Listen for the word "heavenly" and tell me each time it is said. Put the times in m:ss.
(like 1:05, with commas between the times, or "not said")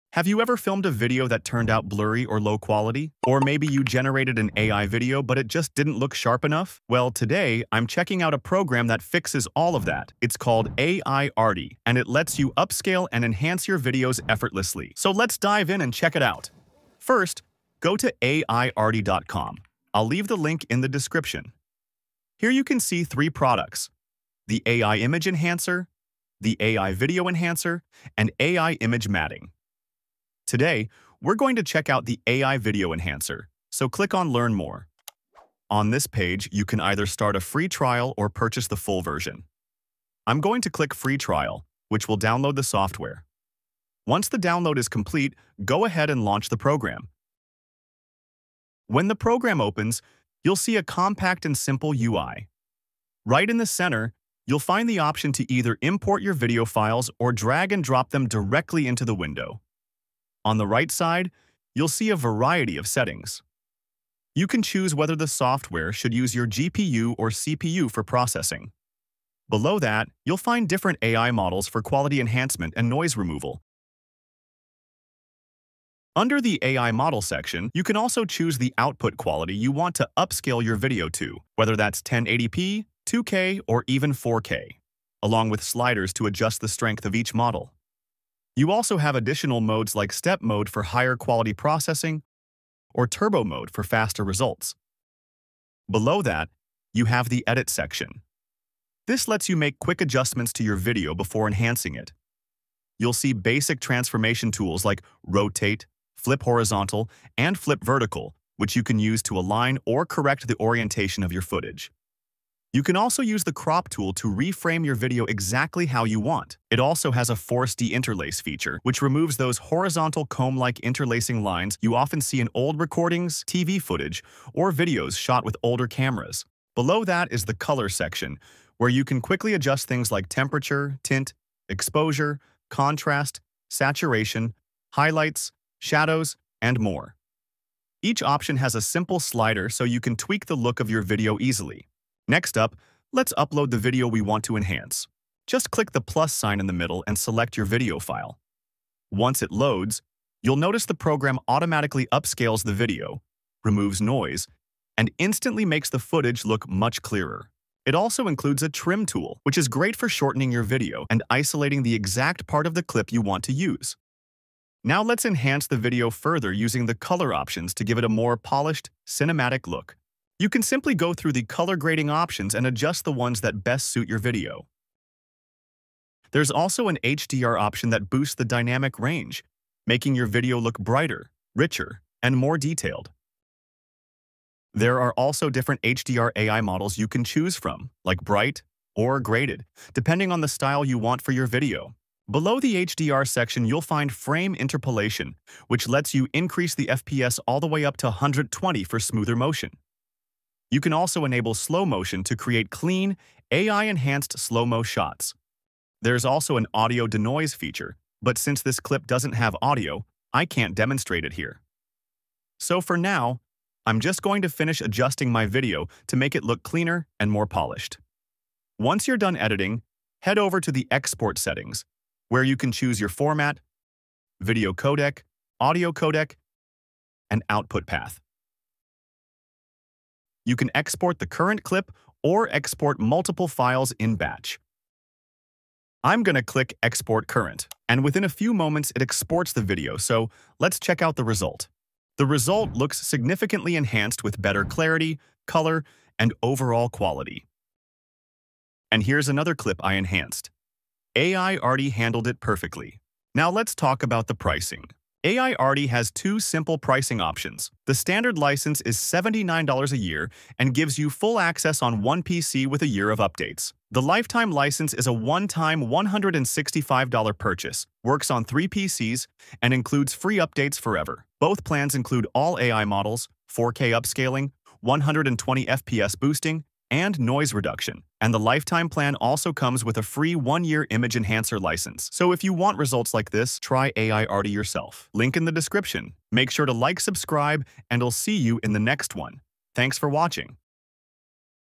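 not said.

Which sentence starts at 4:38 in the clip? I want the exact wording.
And the lifetime plan also comes with a free one-year image enhancer license.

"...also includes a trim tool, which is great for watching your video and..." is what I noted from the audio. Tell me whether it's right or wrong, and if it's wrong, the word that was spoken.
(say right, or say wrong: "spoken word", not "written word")
wrong: "shortening", not "watching".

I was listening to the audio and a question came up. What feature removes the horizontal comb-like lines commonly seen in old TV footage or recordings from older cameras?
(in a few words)
Force deinterlace.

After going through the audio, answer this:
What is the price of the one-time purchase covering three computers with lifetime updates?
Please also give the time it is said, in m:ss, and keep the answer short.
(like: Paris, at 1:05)
$165, at 4:25.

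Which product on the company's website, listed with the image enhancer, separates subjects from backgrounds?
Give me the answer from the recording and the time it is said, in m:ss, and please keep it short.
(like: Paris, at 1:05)
AI Image Matting, at 0:28.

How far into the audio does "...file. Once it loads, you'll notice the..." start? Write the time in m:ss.
2:27.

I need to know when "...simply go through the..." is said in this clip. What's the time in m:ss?
2:50.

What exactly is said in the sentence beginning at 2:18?
Each option has a simple slider so you can tweak the look of your video easily.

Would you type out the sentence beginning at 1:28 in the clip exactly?
You also have additional modes like step mode for higher quality processing or turbo mode for faster results.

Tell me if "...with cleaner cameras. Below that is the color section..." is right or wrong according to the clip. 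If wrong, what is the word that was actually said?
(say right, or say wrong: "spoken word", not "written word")
wrong: "older", not "cleaner".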